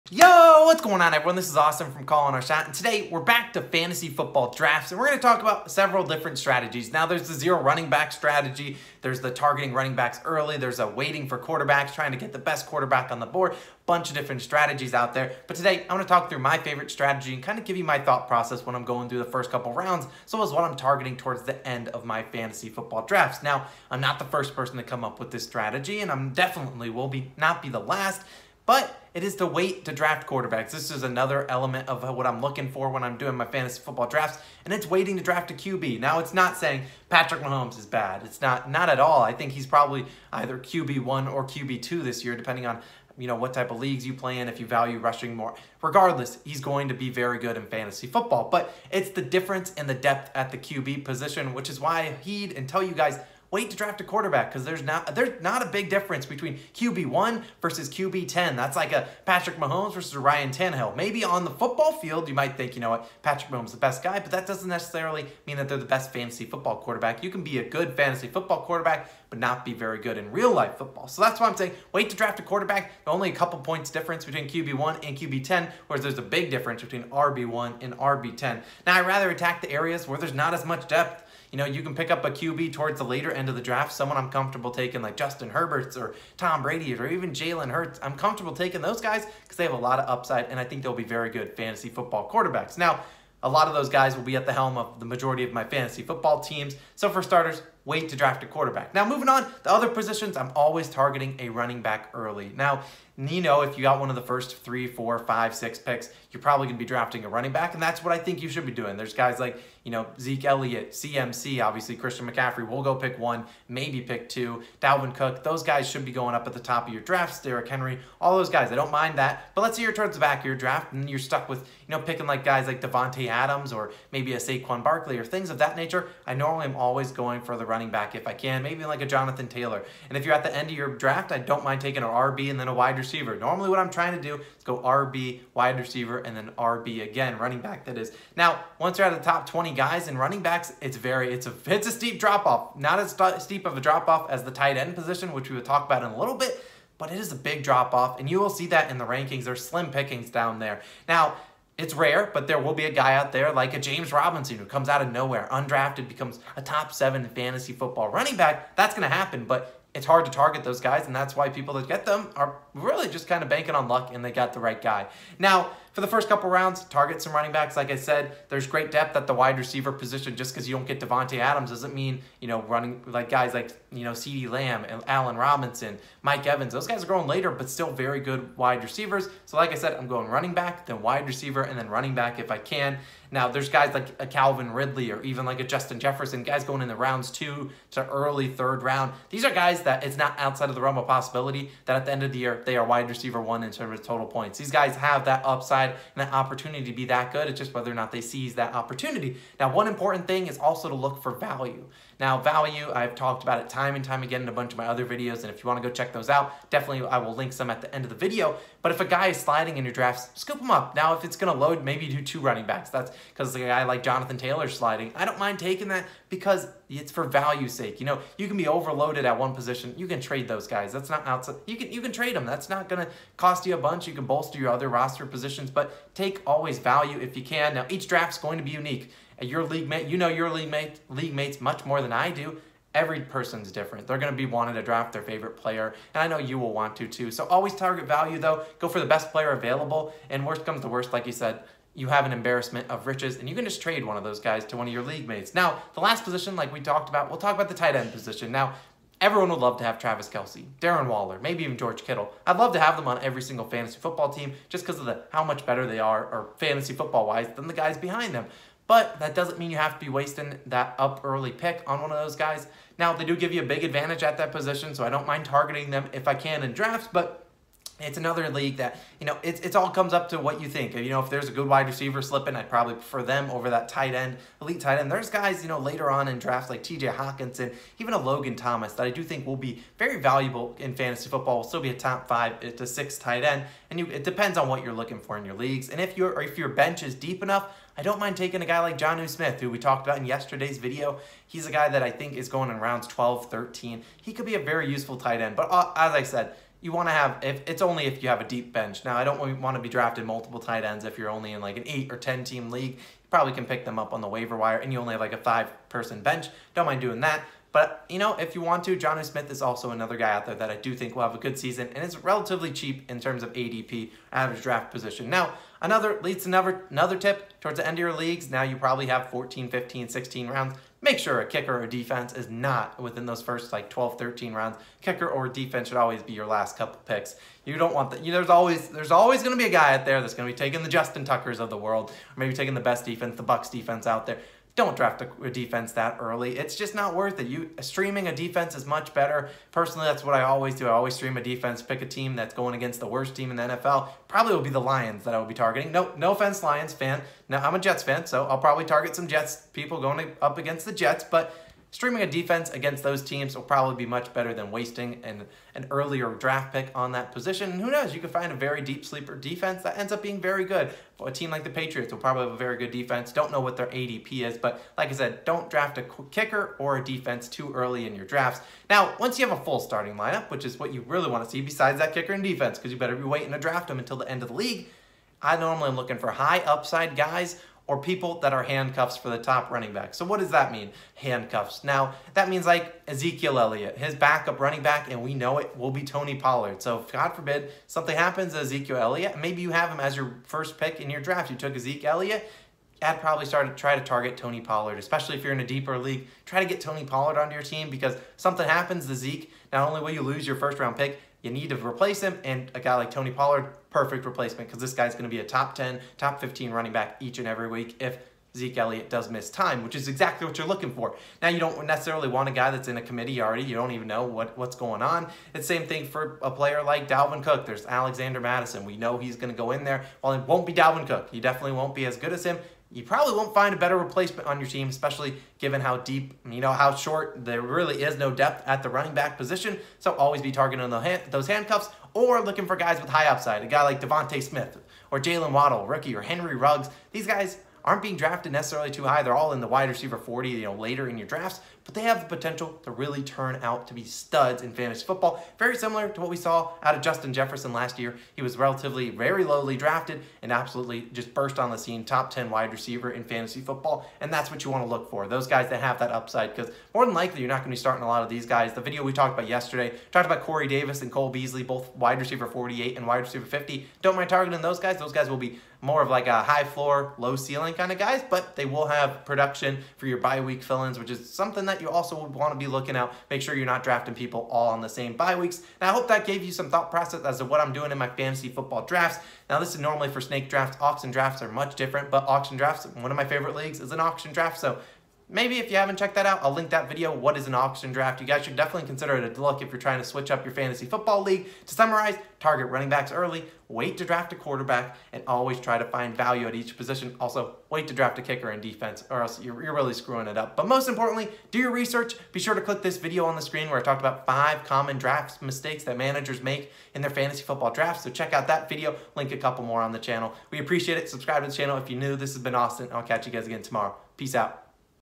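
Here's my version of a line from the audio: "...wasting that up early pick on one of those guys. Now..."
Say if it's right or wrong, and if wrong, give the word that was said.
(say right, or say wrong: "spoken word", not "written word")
right.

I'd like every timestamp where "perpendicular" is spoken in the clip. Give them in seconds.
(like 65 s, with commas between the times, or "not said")
not said.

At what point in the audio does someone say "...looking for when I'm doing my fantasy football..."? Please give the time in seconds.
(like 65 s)
32 s.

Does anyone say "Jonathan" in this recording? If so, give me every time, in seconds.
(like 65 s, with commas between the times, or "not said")
129 s, 214 s.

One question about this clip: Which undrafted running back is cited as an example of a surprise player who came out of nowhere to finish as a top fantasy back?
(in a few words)
James Robinson.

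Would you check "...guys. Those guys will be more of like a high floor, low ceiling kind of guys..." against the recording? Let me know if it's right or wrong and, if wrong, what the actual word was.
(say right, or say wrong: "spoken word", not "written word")
right.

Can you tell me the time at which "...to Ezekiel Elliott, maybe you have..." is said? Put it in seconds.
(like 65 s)
388 s.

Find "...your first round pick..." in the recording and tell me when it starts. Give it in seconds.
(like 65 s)
400 s.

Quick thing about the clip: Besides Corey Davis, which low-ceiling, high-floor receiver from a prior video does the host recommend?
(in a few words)
Cole Beasley.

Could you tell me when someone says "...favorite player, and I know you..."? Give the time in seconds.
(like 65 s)
235 s.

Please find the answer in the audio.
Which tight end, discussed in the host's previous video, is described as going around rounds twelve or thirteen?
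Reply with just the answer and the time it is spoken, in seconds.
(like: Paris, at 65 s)
Jonnu Smith, at 289 s.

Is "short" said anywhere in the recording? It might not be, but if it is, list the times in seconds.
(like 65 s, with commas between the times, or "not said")
426 s.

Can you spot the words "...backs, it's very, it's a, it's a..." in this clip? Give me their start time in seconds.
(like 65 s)
140 s.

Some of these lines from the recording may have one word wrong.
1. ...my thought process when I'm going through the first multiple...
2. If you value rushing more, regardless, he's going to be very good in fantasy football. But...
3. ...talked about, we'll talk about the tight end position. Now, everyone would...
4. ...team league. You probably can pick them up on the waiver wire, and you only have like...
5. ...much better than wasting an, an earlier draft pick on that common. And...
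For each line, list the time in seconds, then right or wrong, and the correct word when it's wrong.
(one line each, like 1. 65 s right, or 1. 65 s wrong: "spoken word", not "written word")
1. 17 s wrong: "couple", not "multiple"
2. 44 s right
3. 246 s right
4. 302 s right
5. 354 s wrong: "position", not "common".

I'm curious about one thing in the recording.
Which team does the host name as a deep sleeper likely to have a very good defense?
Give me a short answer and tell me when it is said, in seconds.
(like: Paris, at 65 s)
Patriots, at 361 s.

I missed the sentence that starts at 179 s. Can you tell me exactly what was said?
So like I said, I'm going running back, then wide receiver, and then running back if I can.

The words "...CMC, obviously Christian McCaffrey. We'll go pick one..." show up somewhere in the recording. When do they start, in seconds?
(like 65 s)
110 s.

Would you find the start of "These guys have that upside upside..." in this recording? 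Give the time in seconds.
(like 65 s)
194 s.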